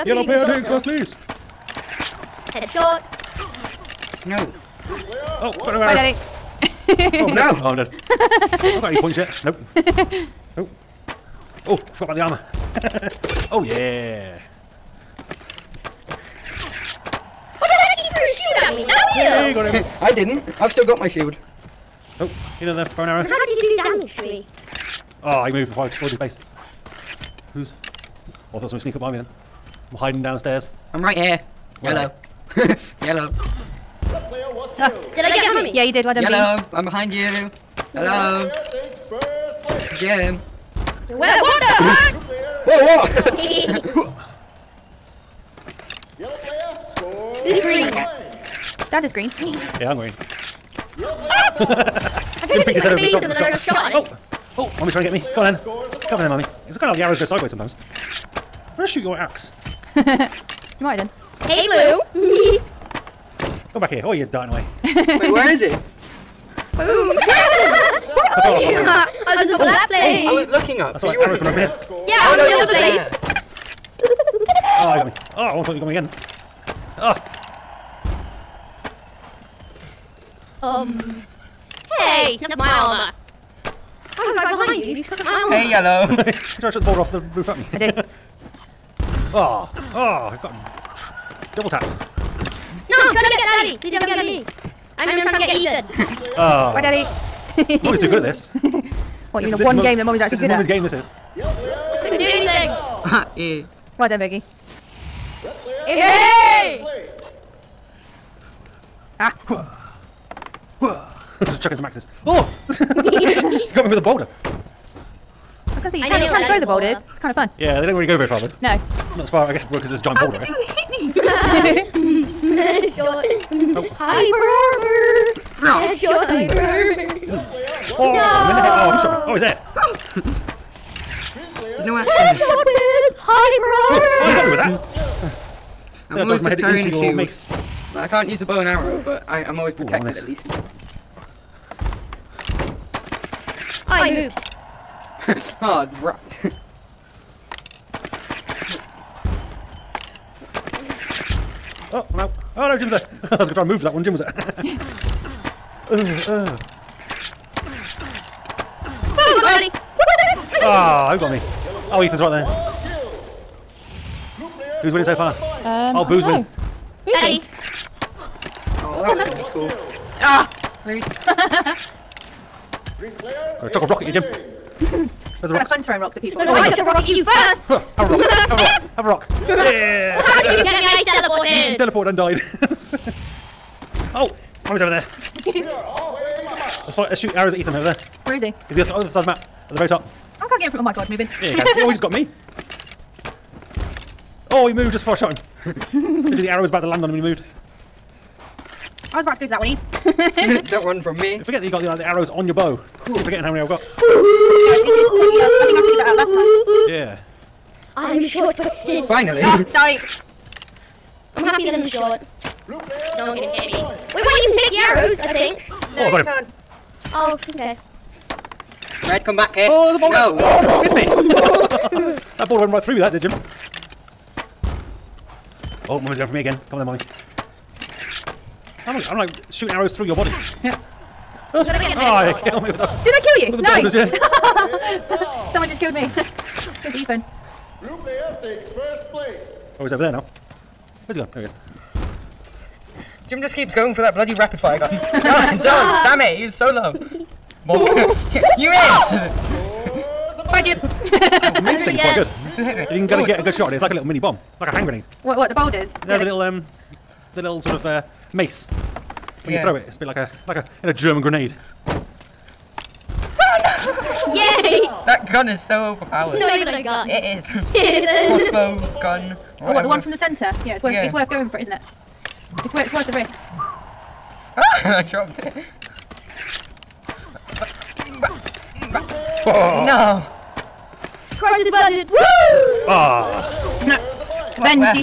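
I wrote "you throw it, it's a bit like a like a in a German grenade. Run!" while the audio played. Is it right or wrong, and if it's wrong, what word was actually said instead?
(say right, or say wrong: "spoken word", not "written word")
right.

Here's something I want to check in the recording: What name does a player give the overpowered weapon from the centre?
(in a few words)
Crossbow gun.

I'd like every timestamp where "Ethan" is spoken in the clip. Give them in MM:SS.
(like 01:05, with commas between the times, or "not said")
01:35, 02:42, 03:07, 03:56.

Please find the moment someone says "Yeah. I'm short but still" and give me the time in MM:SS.
03:27.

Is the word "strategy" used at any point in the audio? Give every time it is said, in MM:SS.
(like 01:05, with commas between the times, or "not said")
not said.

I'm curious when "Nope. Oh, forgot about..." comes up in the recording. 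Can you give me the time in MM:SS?
00:09.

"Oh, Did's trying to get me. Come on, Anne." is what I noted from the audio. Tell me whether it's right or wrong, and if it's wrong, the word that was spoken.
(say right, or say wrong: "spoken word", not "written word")
wrong: "Mummy", not "Did".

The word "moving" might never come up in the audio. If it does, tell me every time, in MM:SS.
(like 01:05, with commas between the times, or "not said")
03:11.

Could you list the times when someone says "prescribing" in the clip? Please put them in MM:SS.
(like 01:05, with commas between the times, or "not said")
not said.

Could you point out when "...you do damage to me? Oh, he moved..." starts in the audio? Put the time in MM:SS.
00:23.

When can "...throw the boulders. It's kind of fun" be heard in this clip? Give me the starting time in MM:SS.
01:56.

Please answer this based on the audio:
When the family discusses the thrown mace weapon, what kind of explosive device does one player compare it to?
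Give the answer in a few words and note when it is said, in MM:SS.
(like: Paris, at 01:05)
hand grenade, at 04:14.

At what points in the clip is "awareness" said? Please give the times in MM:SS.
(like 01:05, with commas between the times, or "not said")
not said.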